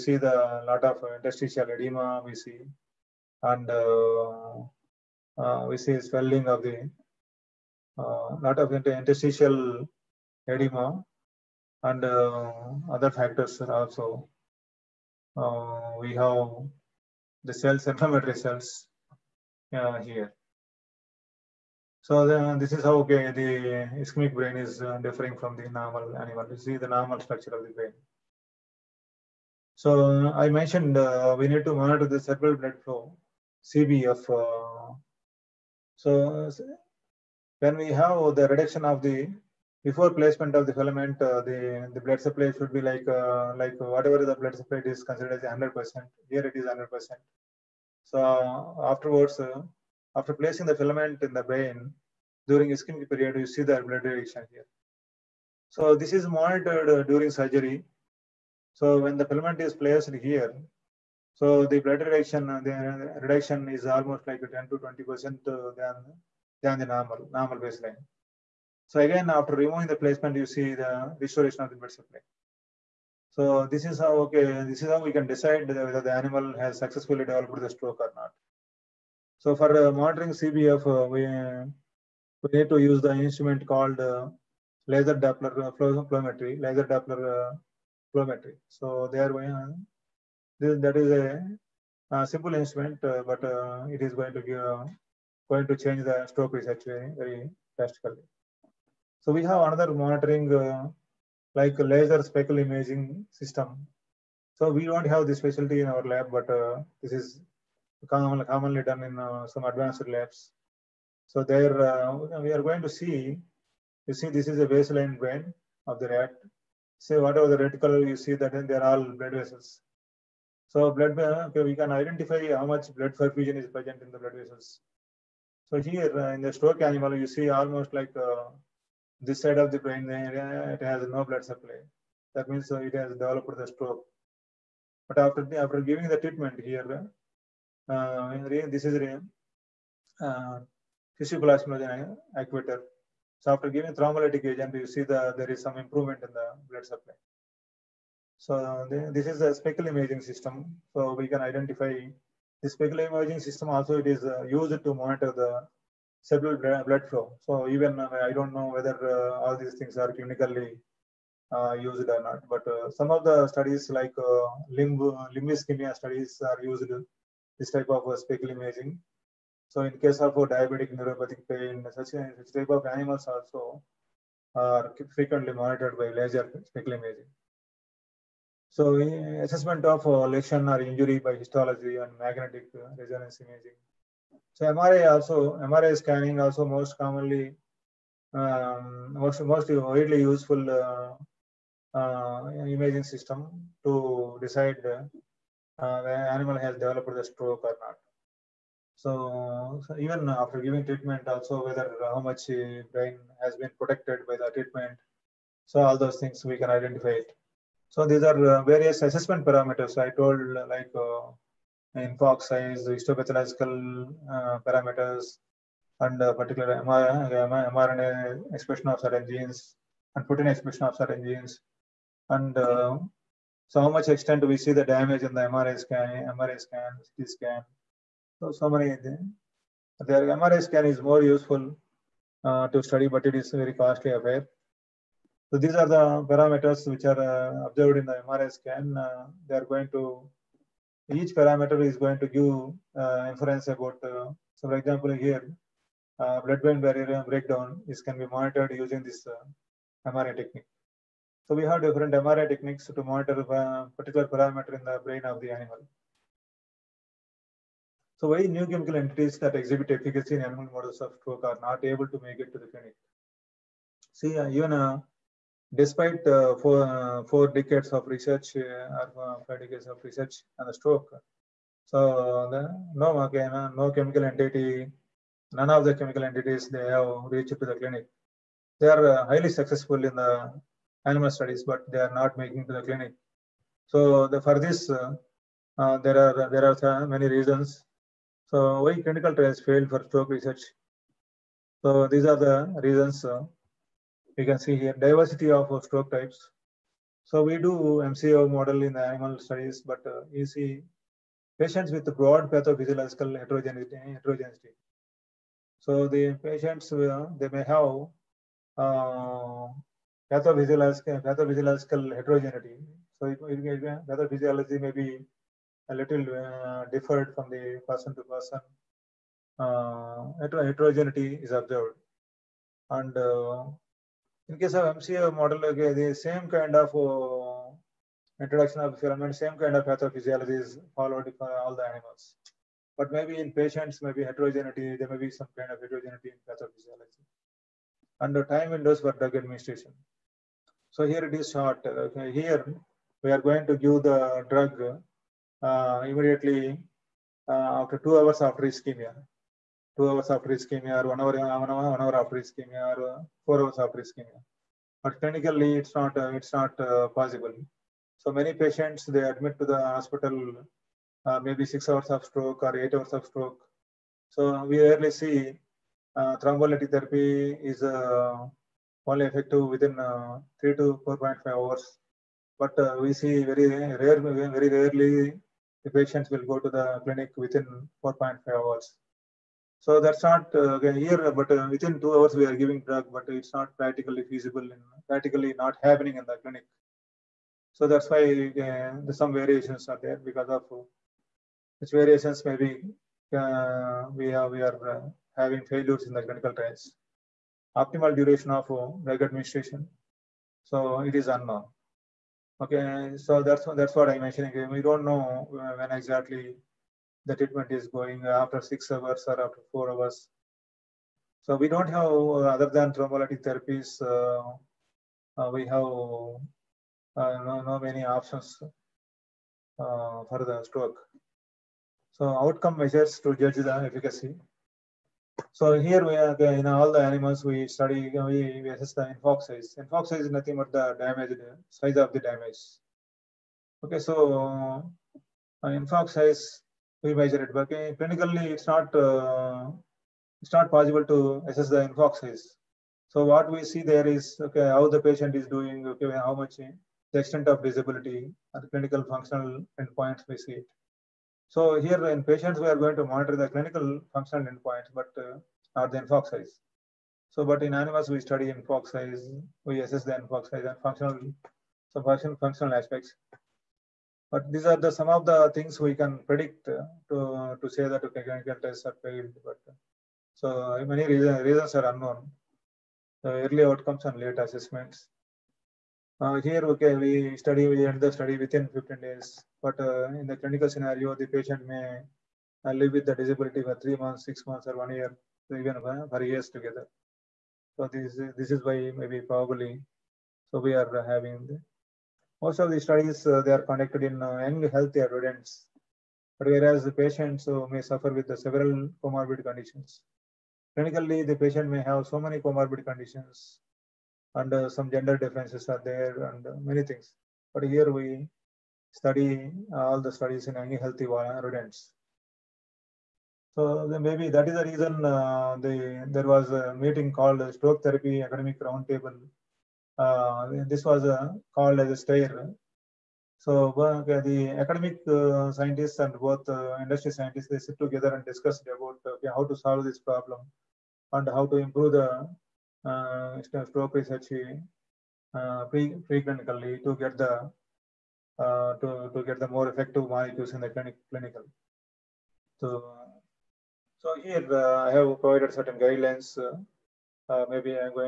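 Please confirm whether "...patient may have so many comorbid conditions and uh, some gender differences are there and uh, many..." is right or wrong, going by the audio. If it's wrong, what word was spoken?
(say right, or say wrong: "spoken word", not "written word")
right.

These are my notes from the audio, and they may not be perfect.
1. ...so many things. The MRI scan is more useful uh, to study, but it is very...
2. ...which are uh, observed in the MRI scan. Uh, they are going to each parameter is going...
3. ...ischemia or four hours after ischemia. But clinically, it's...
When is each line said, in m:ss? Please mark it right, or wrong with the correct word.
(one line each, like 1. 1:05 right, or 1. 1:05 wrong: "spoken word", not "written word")
1. 3:48 right
2. 3:56 right
3. 5:52 right.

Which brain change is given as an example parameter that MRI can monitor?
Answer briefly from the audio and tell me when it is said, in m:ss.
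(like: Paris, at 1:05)
Blood-brain barrier breakdown, at 4:06.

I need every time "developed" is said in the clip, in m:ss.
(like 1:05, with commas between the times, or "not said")
1:17, 2:13, 3:16.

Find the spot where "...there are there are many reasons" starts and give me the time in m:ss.
4:45.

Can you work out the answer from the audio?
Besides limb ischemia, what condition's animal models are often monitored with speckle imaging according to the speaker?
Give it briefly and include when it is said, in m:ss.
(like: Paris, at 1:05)
Diabetic neuropathic pain, at 2:50.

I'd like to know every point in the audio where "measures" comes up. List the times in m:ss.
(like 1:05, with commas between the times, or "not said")
7:02, 7:17.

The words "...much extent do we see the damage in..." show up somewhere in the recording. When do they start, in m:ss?
3:43.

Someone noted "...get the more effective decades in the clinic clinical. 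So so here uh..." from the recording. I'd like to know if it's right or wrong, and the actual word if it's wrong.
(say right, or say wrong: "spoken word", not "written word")
wrong: "molecules", not "decades".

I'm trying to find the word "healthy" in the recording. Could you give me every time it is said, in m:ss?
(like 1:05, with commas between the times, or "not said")
8:14, 8:30.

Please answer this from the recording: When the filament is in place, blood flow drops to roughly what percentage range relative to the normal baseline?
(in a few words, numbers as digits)
10 to 20%.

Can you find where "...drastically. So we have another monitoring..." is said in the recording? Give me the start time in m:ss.
1:37.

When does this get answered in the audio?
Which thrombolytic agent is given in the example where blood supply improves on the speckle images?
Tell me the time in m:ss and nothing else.
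2:21.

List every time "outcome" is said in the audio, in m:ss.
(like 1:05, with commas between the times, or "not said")
7:02, 7:53.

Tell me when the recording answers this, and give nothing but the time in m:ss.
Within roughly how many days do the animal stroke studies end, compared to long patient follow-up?
7:58.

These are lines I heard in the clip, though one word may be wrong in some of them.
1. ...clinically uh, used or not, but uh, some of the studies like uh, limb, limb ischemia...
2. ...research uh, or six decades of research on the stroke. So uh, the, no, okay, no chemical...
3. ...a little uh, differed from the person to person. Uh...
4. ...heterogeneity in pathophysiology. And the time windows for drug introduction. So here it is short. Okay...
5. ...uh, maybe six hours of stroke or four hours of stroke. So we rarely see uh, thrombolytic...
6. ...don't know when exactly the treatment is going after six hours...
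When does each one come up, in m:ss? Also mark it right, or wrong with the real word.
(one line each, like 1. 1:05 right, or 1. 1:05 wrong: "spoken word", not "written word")
1. 2:40 right
2. 4:28 wrong: "five", not "six"
3. 5:15 right
4. 5:35 wrong: "administration", not "introduction"
5. 6:01 wrong: "eight", not "four"
6. 6:44 right.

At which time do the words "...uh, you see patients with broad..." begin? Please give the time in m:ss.
5:00.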